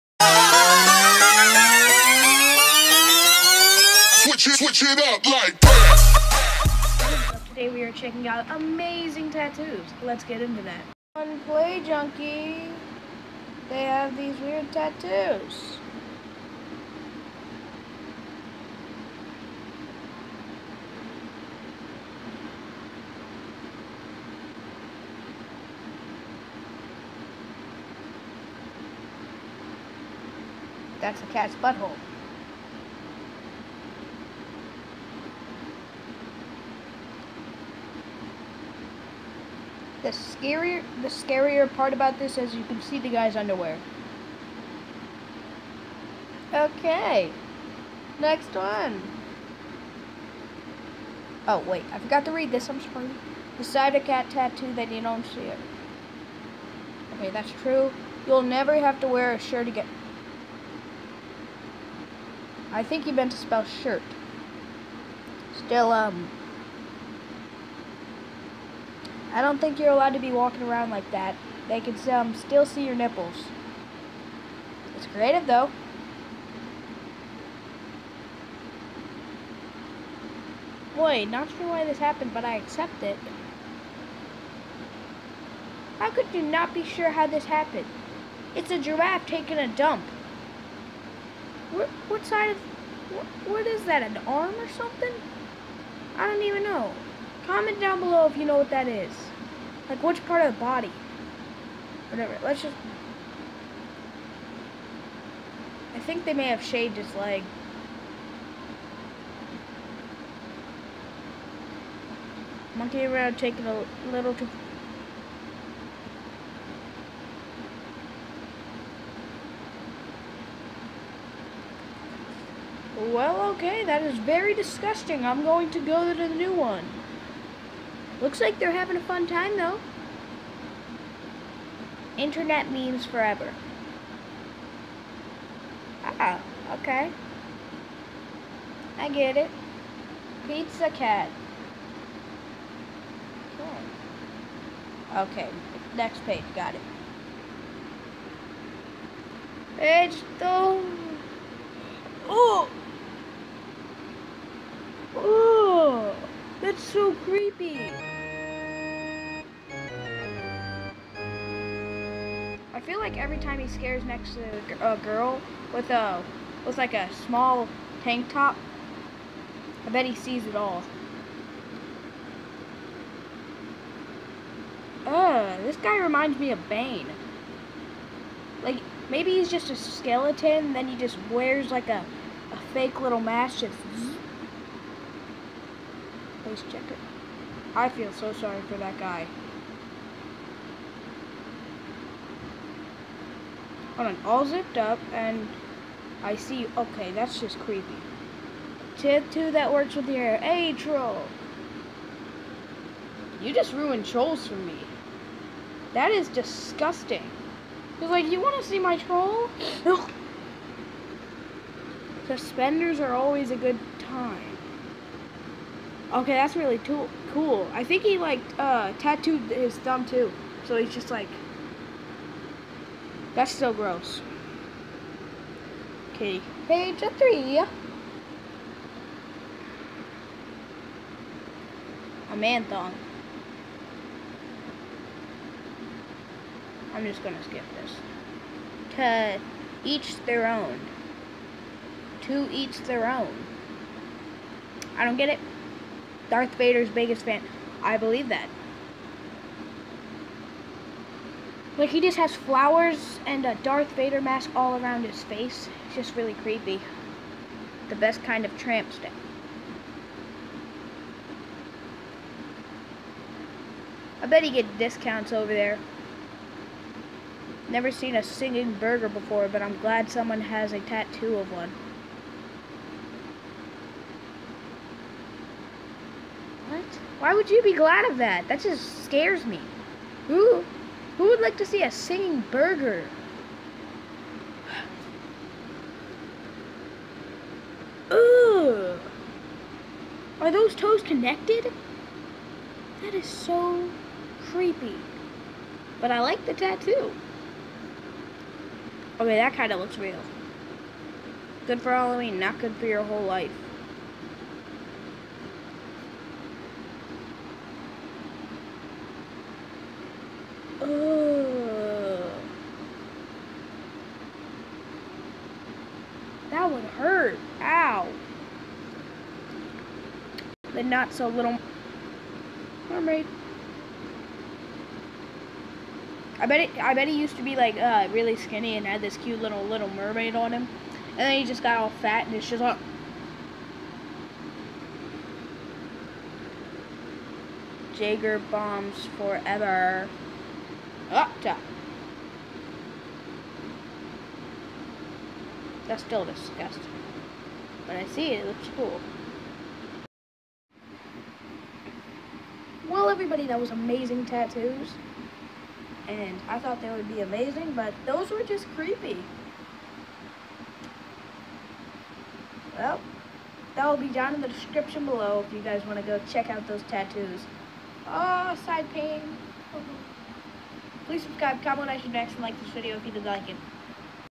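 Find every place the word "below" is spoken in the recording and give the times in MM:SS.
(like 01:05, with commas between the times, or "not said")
01:37, 06:05.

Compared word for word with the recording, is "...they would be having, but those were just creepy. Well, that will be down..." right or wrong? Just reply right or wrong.
wrong.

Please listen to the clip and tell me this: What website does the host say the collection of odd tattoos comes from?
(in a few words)
Play Junkie.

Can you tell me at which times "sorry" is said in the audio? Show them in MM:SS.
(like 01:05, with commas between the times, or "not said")
00:52, 03:08.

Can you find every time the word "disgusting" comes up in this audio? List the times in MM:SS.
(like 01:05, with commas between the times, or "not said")
02:04, 03:26, 05:46.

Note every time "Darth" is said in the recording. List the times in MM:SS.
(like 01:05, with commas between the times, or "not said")
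04:06, 04:13.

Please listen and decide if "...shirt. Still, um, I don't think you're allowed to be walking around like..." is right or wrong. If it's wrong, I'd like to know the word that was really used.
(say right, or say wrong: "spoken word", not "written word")
right.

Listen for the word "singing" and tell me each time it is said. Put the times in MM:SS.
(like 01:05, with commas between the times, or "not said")
04:28, 04:41.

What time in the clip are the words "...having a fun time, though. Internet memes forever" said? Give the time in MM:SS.
02:08.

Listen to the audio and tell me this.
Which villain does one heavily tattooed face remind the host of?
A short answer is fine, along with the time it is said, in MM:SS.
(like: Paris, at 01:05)
Bane, at 02:56.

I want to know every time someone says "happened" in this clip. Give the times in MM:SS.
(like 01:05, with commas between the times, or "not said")
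01:21, 01:27.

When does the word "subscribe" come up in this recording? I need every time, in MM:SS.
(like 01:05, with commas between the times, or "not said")
06:11.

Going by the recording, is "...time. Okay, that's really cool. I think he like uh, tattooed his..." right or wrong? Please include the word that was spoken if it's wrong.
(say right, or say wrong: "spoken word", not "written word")
right.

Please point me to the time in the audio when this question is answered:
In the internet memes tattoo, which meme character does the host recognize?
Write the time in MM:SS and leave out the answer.
02:20.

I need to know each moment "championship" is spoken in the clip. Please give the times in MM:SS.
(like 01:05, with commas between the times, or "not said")
not said.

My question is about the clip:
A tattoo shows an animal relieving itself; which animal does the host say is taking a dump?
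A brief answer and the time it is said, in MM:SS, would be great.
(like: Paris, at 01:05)
Giraffe, at 01:28.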